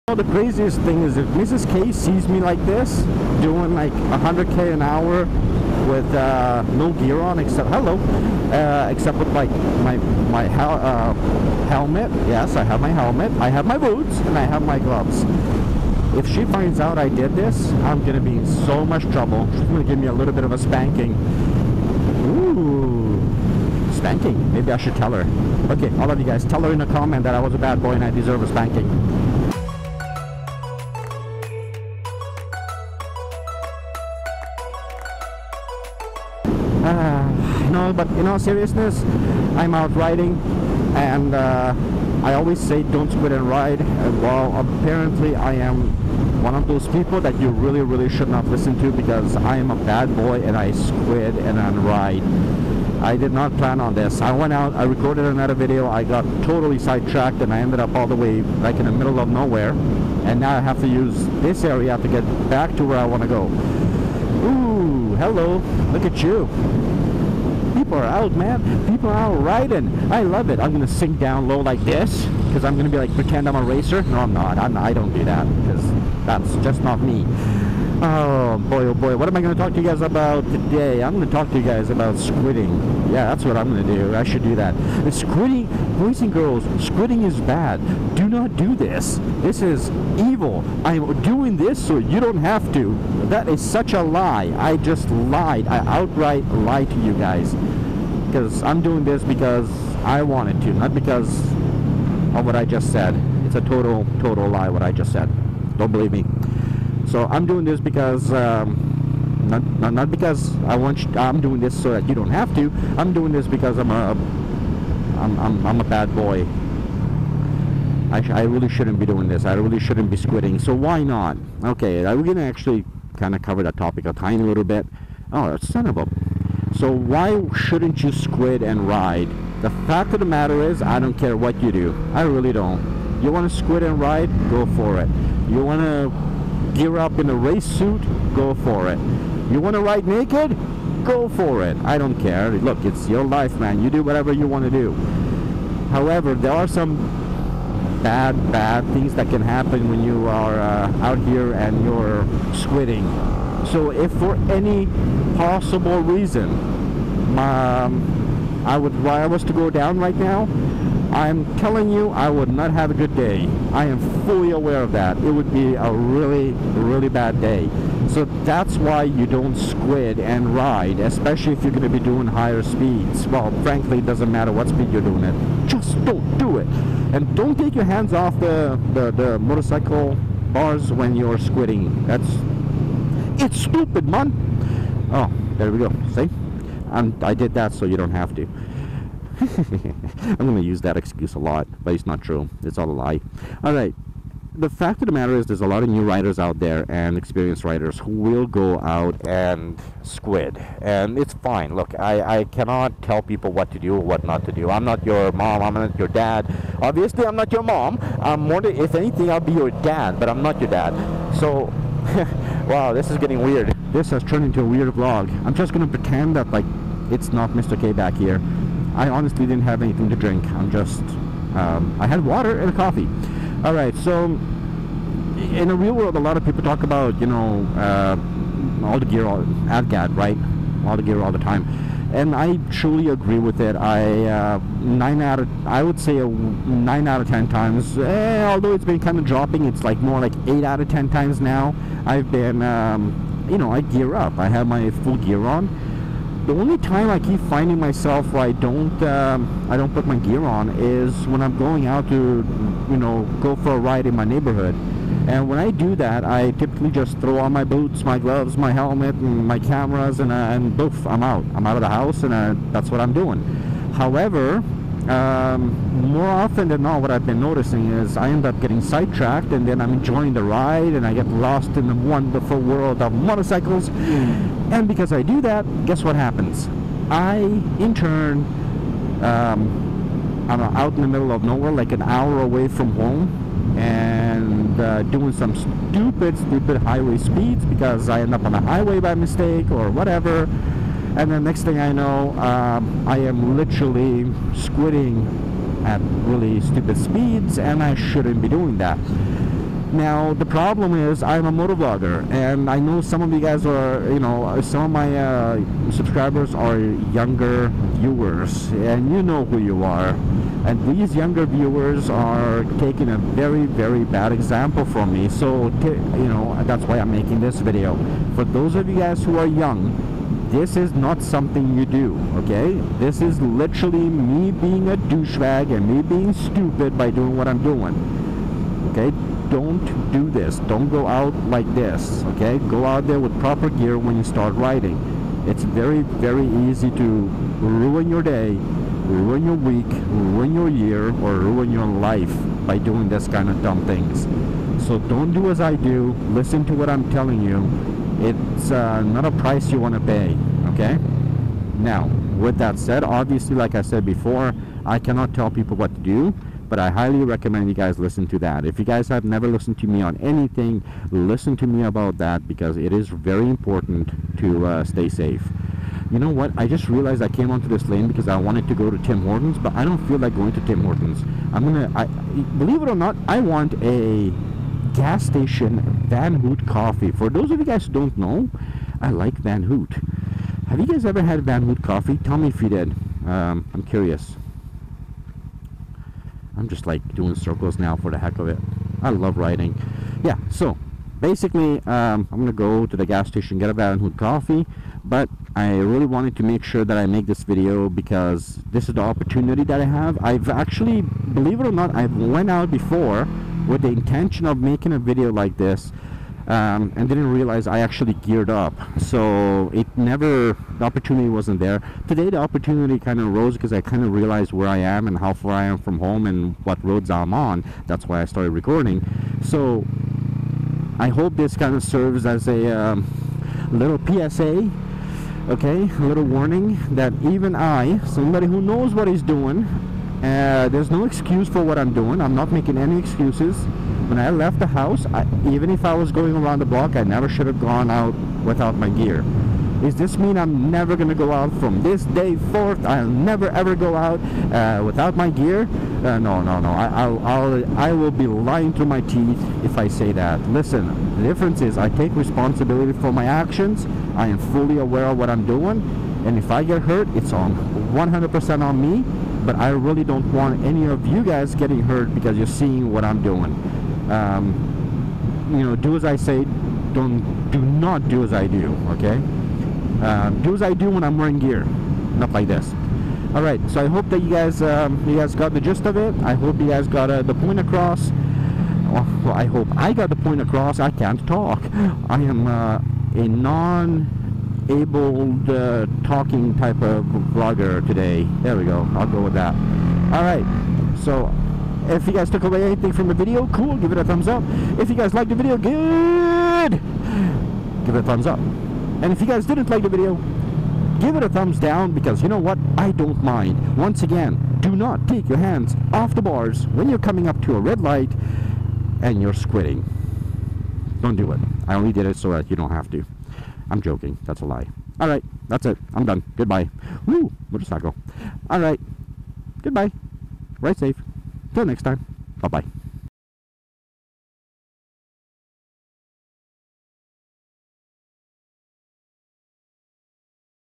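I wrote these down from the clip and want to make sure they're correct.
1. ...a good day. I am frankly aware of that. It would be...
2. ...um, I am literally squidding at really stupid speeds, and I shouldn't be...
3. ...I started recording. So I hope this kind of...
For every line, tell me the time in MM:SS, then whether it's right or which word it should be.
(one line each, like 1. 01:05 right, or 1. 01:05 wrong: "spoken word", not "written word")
1. 02:42 wrong: "fully", not "frankly"
2. 04:52 right
3. 06:58 right.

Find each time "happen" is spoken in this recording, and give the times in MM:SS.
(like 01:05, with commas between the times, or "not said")
02:29, 04:36.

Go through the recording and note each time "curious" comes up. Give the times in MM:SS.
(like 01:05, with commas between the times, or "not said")
06:23.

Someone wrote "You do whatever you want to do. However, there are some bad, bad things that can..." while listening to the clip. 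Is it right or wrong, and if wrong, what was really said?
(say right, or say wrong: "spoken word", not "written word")
right.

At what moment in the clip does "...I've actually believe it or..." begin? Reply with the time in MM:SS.
06:40.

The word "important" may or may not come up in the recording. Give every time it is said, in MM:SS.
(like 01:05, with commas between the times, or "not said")
06:03.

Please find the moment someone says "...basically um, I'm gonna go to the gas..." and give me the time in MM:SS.
06:31.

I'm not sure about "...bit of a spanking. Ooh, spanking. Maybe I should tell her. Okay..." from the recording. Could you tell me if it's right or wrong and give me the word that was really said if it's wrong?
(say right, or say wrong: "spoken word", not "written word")
right.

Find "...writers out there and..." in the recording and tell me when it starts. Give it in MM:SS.
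03:16.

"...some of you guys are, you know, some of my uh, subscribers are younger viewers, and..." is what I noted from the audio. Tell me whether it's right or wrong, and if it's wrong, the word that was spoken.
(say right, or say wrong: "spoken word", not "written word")
right.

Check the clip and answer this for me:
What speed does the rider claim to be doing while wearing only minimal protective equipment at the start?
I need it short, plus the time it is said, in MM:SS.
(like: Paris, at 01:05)
100k an hour, at 00:03.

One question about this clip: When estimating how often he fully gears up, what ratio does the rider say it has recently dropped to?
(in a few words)
8 out of 10.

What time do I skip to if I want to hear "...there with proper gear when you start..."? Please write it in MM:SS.
05:33.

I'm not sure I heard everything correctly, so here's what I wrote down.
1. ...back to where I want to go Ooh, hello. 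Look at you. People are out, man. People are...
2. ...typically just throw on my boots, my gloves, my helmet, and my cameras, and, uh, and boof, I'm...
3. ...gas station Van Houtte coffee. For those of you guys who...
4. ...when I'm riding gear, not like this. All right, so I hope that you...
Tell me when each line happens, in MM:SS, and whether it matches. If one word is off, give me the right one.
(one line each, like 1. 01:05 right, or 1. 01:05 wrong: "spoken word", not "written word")
1. 01:02 right
2. 04:16 right
3. 06:14 right
4. 07:50 wrong: "wearing", not "riding".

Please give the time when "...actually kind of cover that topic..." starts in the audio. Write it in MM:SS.
02:02.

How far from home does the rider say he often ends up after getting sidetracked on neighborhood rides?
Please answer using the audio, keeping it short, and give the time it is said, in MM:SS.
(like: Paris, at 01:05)
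An hour away, at 04:41.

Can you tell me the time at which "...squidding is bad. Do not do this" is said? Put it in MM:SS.
01:26.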